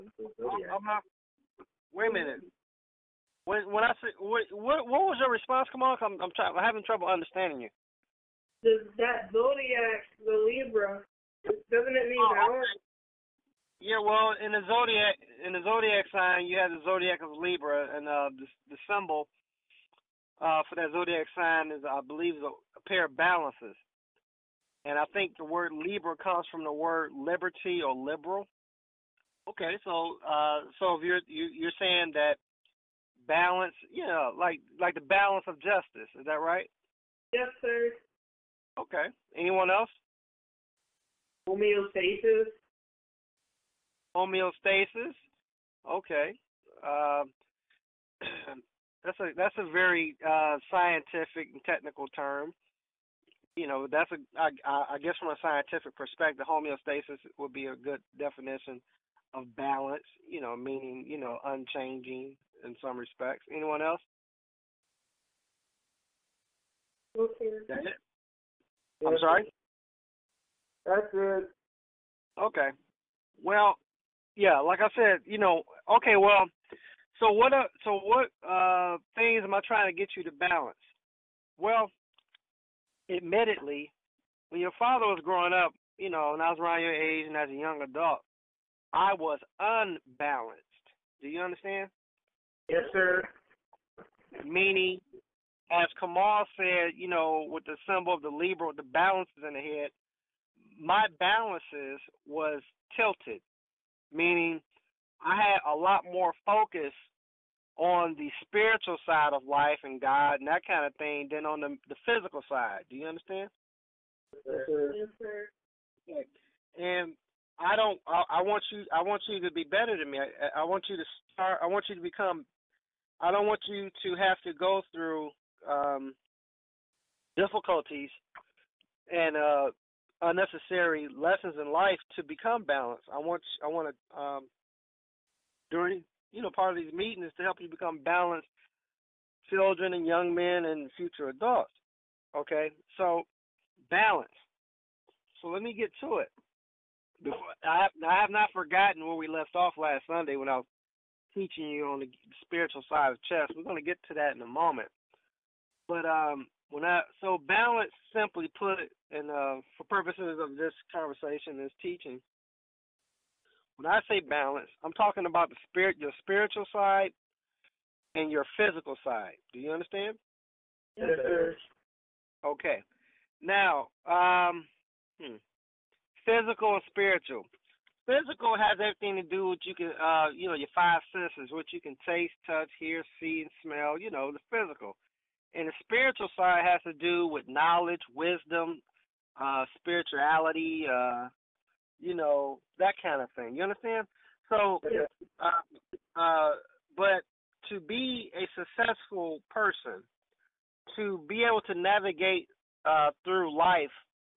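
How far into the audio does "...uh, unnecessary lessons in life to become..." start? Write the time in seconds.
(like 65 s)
129 s.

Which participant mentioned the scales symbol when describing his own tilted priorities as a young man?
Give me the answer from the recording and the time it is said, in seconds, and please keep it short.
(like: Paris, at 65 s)
Kamal, at 95 s.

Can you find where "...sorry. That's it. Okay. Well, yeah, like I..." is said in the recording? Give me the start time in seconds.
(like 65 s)
69 s.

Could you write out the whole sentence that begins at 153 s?
We're going to get to that in a moment.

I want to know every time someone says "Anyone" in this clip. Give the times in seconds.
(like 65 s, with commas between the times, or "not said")
39 s, 63 s.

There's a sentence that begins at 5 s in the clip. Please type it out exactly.
Come on, I'm I'm, trying, I'm having trouble understanding you.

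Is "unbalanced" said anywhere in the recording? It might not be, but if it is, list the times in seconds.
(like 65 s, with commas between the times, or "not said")
89 s.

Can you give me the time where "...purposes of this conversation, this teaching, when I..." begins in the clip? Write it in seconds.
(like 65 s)
159 s.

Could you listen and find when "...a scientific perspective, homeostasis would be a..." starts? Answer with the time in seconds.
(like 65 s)
55 s.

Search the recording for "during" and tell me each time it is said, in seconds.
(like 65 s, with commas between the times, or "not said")
135 s.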